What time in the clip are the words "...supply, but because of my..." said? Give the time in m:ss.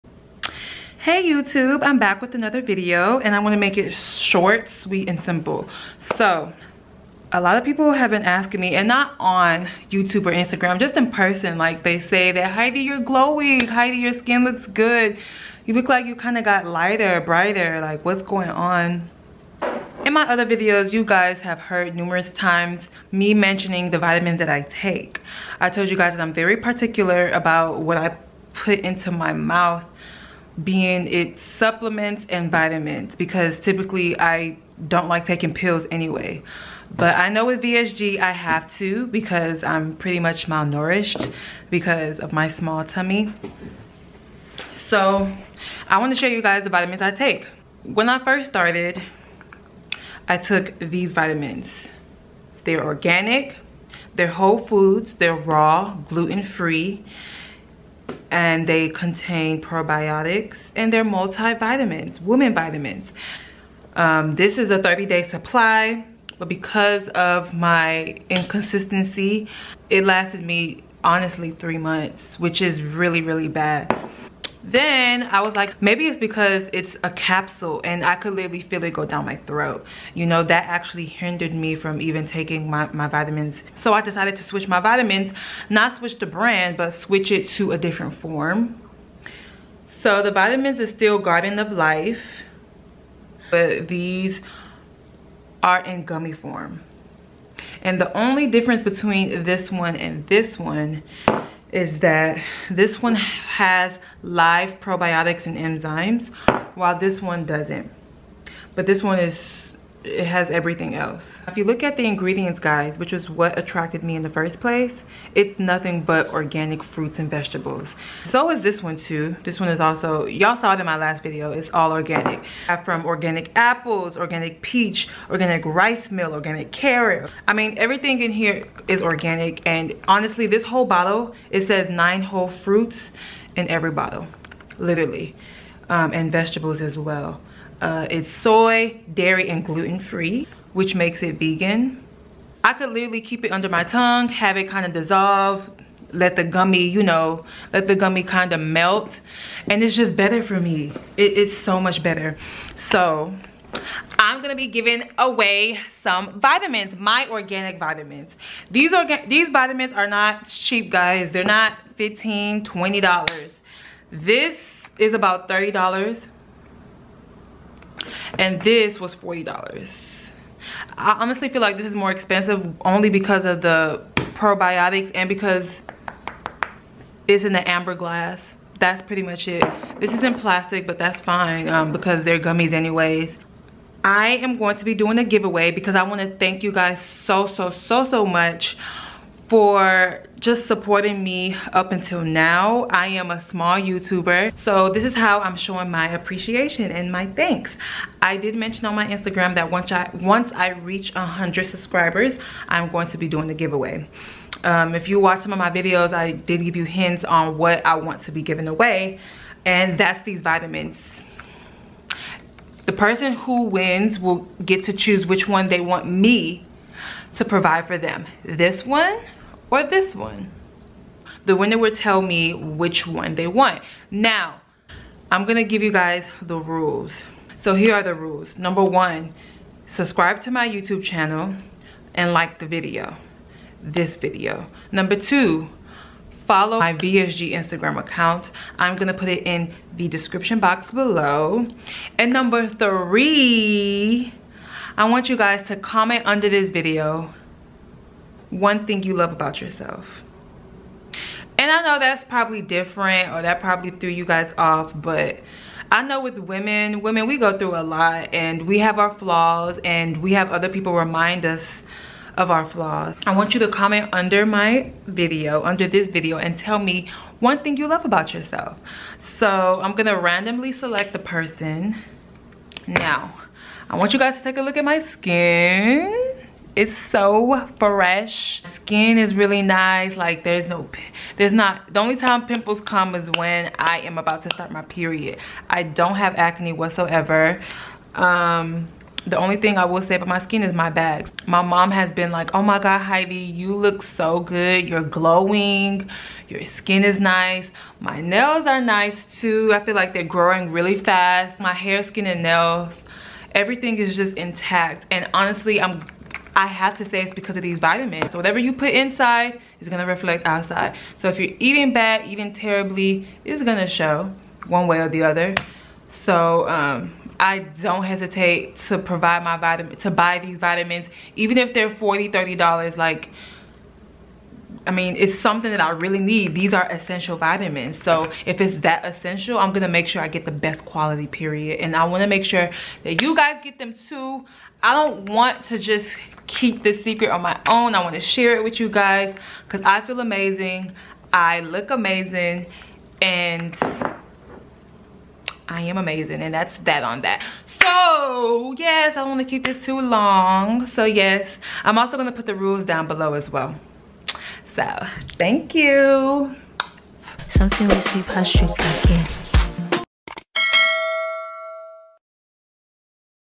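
1:05.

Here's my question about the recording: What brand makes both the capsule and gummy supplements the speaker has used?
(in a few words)
Garden of Life.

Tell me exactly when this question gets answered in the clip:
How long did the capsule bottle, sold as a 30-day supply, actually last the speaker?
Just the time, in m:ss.
1:11.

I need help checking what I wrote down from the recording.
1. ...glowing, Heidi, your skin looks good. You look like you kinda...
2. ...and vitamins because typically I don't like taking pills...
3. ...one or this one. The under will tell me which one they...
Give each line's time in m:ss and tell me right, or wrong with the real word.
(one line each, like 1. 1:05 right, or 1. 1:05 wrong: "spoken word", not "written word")
1. 0:12 right
2. 0:32 right
3. 3:38 wrong: "winner", not "under".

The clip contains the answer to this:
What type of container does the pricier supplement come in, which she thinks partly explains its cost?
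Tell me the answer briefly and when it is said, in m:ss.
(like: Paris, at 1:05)
amber glass, at 2:57.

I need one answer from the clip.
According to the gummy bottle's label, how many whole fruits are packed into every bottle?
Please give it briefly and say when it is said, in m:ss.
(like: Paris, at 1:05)
9, at 2:11.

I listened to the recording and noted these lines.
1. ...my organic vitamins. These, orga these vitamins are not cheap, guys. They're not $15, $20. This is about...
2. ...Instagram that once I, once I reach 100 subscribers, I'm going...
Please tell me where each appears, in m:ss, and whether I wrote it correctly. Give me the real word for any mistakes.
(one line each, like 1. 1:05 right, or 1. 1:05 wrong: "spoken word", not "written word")
1. 2:36 right
2. 3:19 right.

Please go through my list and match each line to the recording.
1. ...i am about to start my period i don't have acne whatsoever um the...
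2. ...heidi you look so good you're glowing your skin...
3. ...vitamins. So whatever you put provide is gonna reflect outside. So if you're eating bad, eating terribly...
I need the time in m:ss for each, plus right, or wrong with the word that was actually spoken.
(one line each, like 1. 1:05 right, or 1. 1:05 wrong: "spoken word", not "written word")
1. 4:43 right
2. 4:52 right
3. 5:07 wrong: "inside", not "provide".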